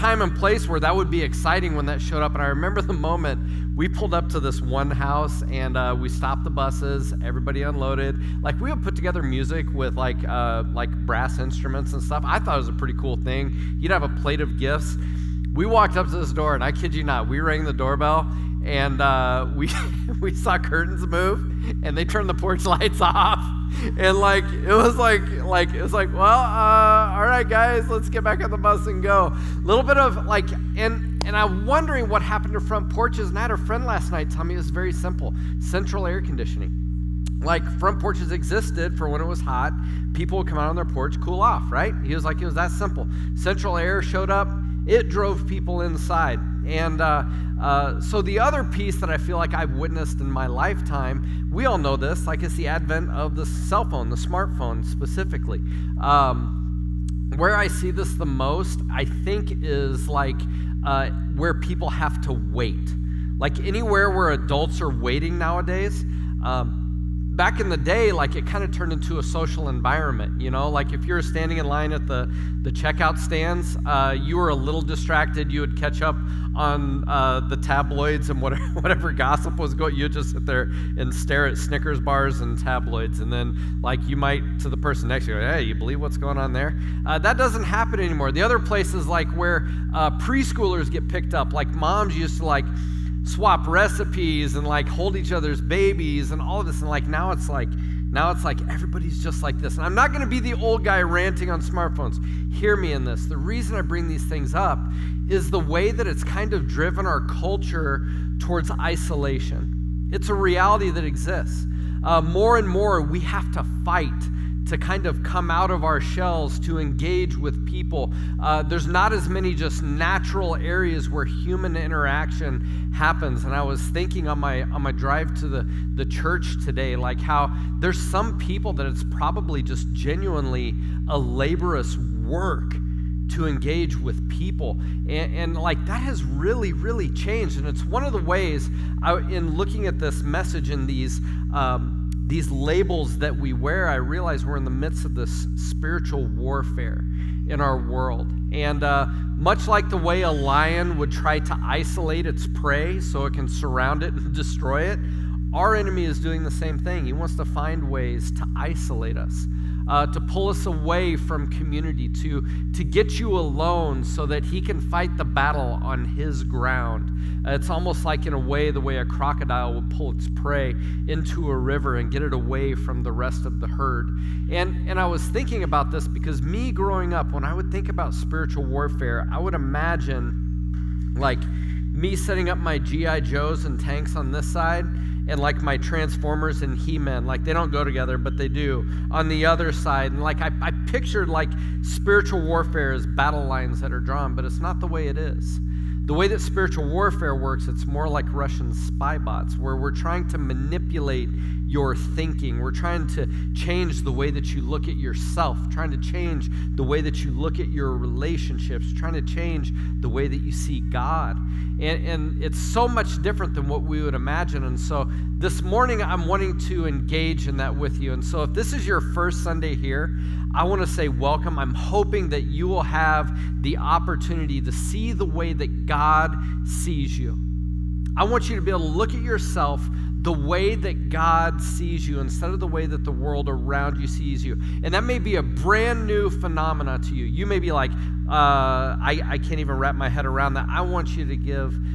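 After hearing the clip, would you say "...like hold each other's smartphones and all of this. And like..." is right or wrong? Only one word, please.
wrong.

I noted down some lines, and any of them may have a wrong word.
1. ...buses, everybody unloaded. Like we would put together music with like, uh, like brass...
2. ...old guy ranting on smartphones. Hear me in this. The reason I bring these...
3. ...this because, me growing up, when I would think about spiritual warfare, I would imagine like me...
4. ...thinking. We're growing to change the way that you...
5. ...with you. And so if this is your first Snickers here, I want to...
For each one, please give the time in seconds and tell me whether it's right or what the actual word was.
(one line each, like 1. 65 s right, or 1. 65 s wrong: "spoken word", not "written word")
1. 6 s right
2. 100 s right
3. 175 s right
4. 201 s wrong: "trying", not "growing"
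5. 217 s wrong: "Sunday", not "Snickers".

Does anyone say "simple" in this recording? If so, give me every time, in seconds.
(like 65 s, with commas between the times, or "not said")
34 s, 42 s.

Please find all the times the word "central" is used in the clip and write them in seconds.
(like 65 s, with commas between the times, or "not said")
35 s, 43 s.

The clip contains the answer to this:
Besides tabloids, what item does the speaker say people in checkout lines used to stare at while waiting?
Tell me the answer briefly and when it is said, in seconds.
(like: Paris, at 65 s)
Snickers bars, at 81 s.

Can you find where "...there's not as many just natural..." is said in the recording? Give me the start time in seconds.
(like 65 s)
118 s.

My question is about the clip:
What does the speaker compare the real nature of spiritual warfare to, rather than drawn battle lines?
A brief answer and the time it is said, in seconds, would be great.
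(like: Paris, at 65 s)
Russian spy bots, at 198 s.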